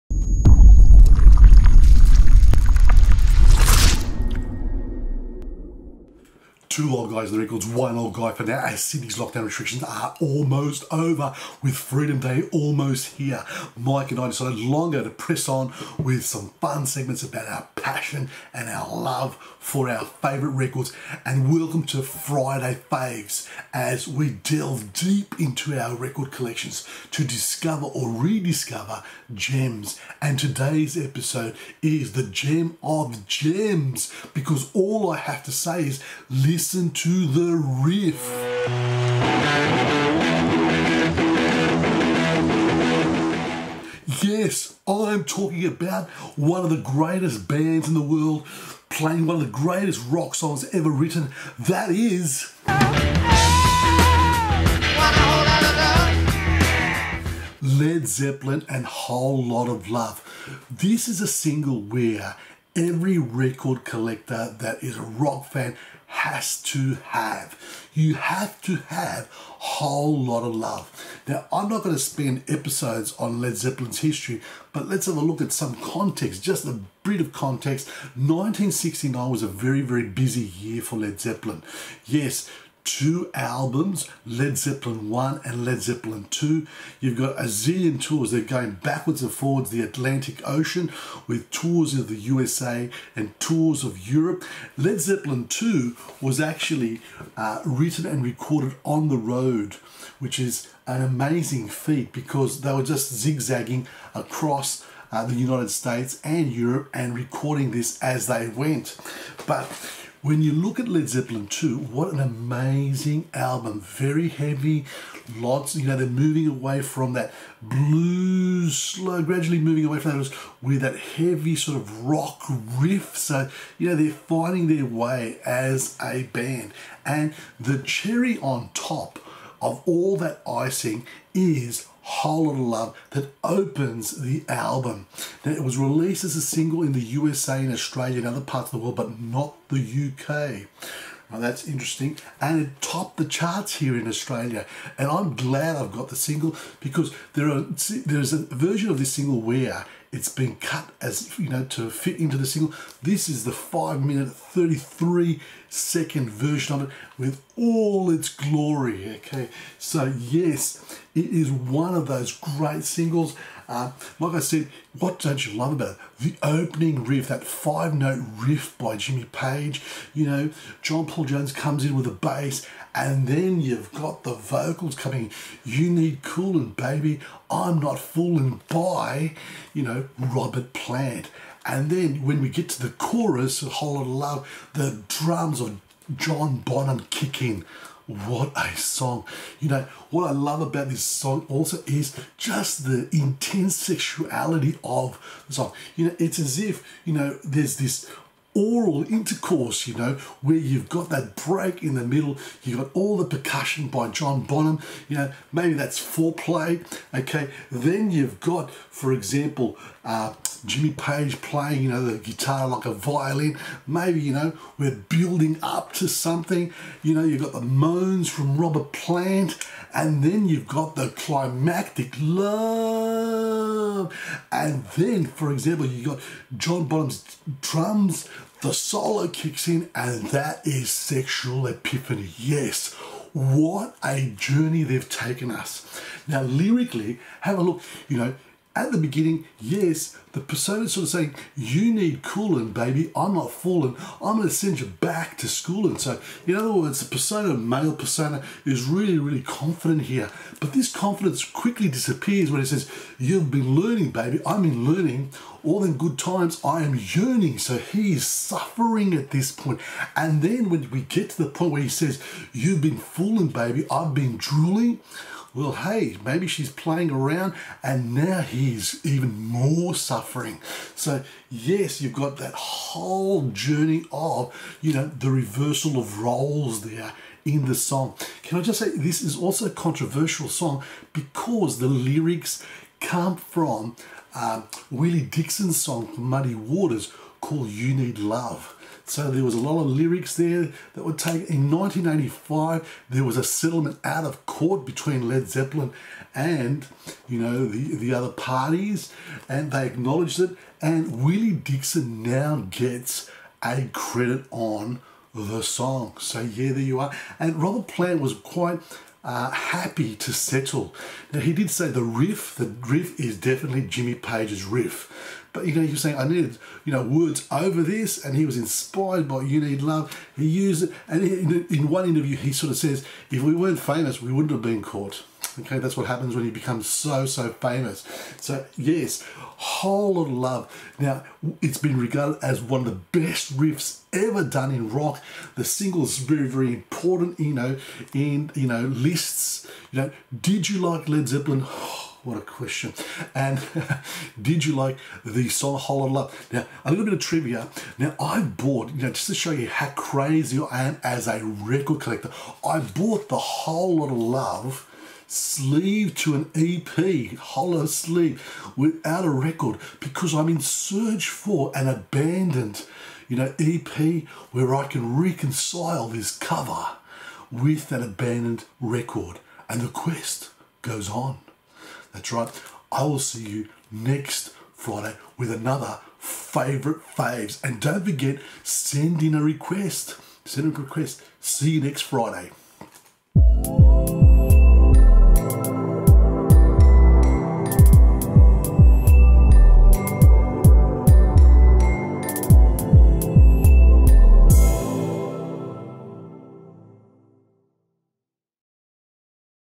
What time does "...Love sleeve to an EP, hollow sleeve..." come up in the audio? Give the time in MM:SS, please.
05:54.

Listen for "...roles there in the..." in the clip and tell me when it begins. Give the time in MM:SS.
04:36.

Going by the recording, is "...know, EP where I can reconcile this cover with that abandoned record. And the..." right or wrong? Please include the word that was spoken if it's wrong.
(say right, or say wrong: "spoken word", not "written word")
right.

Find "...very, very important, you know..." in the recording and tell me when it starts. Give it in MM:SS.
05:36.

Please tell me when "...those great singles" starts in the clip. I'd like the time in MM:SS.
02:42.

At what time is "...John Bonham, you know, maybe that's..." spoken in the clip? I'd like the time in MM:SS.
03:24.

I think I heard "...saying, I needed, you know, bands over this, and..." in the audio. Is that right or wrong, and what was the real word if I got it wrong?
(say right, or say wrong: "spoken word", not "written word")
wrong: "words", not "bands".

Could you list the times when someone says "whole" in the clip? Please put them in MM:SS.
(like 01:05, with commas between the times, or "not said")
00:58, 01:09, 02:12, 03:03, 04:32, 05:29, 05:45, 05:53.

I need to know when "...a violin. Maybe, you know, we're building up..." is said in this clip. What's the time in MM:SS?
03:32.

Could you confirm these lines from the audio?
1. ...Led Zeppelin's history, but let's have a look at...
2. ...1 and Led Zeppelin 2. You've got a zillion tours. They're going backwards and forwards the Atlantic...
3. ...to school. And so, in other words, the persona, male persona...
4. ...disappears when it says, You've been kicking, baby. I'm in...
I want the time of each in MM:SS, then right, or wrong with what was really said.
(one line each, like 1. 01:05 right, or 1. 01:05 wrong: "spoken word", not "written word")
1. 01:13 right
2. 01:25 right
3. 04:05 right
4. 04:11 wrong: "learning", not "kicking".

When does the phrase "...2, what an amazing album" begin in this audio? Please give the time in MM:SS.
01:51.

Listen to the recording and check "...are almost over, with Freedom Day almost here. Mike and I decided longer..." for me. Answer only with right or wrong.
right.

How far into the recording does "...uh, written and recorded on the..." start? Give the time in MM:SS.
01:37.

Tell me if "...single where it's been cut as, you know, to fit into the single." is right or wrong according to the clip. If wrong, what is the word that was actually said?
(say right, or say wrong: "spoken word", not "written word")
right.